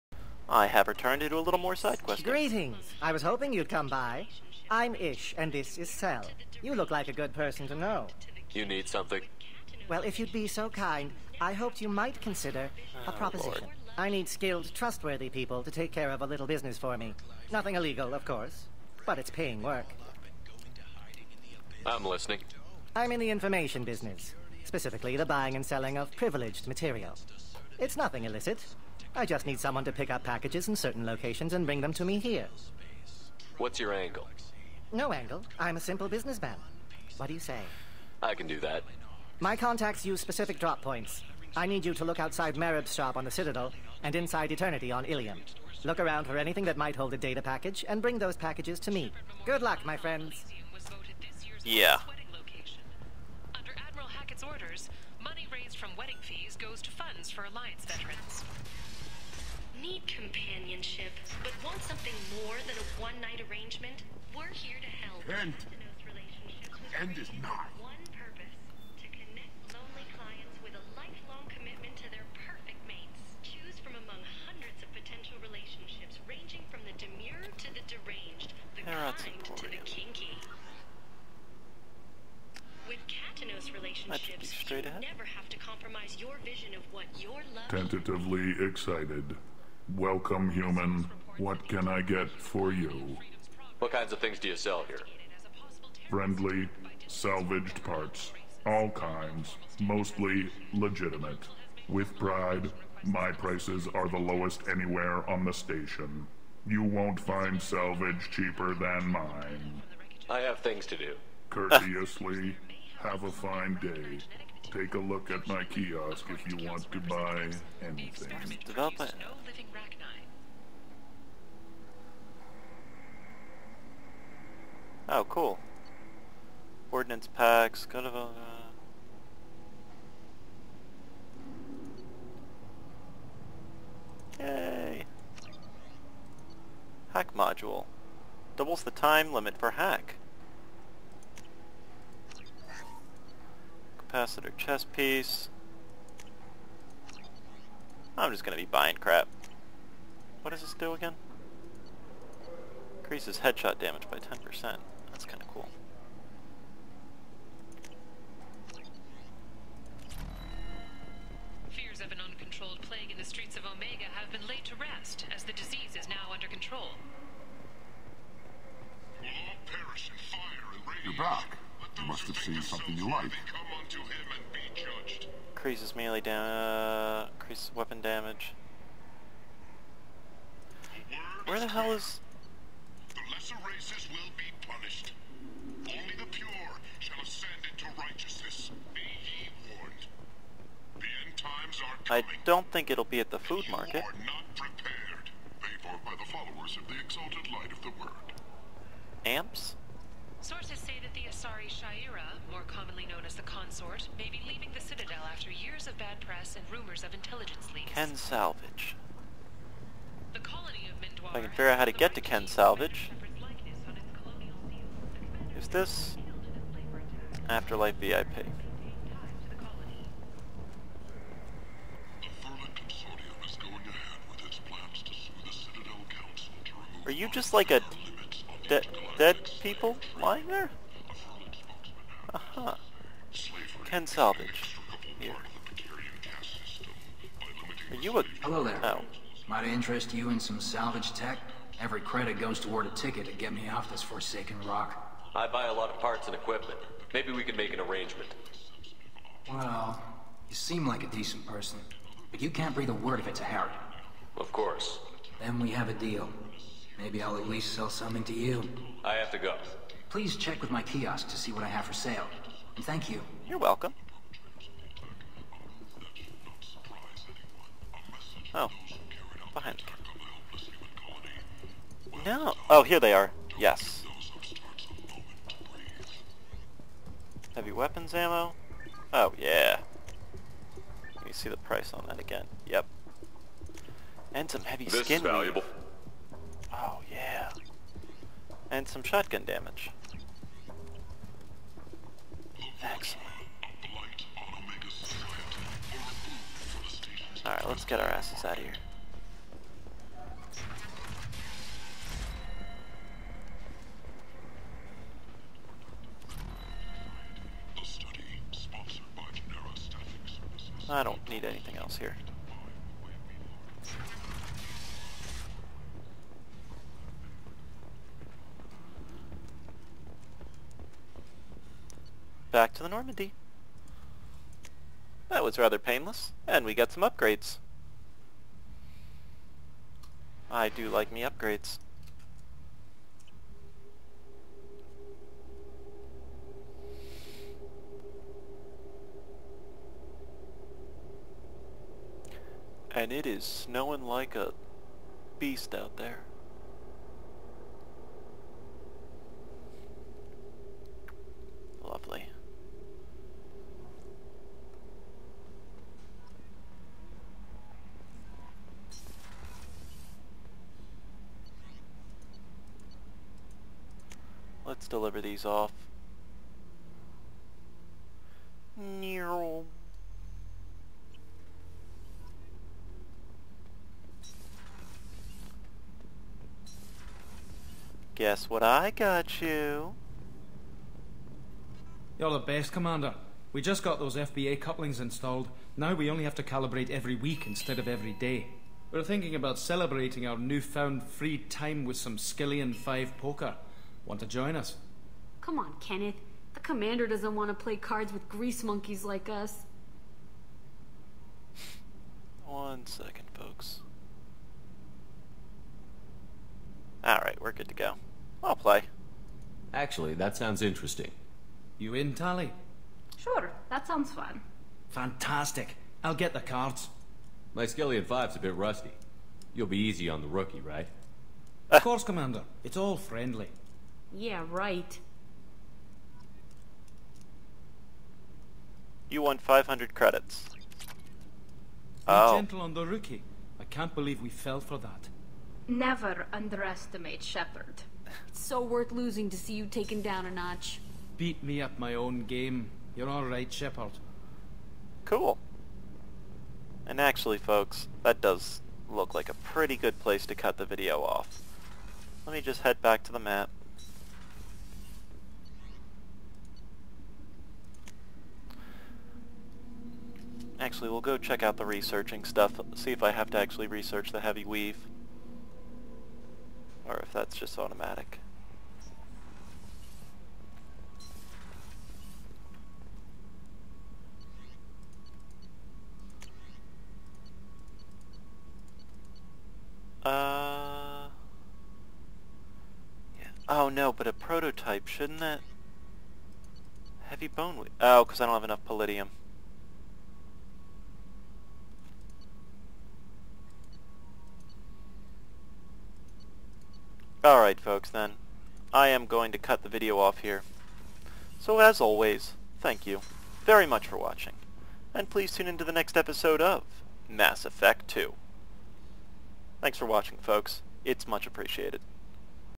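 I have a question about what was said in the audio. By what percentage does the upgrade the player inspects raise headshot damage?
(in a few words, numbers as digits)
10%.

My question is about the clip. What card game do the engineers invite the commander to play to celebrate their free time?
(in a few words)
Skyllian 5 poker.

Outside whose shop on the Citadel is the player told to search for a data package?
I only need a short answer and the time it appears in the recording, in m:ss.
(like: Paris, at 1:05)
Merib, at 0:42.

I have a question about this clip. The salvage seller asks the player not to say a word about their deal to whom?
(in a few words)
Harrot.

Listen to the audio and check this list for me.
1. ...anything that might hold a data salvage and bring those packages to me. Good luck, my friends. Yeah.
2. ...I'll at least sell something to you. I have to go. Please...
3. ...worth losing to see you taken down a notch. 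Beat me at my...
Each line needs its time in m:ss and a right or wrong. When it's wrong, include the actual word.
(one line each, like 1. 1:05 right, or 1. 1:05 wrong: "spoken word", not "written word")
1. 0:46 wrong: "package", not "salvage"
2. 4:17 right
3. 7:18 right.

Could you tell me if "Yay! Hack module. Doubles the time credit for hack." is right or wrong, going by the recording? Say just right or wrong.
wrong.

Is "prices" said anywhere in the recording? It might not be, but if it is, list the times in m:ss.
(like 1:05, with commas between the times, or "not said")
1:43, 4:41.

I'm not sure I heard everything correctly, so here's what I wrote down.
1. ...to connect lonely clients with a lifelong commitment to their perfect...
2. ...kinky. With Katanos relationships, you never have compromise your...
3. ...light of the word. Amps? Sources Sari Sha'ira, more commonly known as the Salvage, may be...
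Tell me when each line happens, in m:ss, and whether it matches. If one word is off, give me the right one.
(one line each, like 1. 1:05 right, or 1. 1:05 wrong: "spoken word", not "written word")
1. 1:09 right
2. 1:19 right
3. 3:17 wrong: "Consort", not "Salvage".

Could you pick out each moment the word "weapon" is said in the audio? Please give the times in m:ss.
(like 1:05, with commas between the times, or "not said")
2:57, 4:37.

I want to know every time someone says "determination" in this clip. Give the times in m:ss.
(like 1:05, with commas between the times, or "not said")
not said.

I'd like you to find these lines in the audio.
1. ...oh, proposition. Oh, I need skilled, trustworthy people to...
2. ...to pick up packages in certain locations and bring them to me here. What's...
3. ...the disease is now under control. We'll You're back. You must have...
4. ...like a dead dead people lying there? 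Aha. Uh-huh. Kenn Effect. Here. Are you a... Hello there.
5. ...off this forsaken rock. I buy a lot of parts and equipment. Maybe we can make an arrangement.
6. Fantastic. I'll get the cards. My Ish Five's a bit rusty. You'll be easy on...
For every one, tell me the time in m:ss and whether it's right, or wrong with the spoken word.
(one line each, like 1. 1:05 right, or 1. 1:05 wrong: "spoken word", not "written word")
1. 0:13 right
2. 0:29 right
3. 2:45 right
4. 3:47 wrong: "Salvage", not "Effect"
5. 4:03 right
6. 6:54 wrong: "Skyllian", not "Ish".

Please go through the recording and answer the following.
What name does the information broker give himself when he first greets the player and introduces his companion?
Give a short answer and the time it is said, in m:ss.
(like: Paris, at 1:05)
Ish, at 0:04.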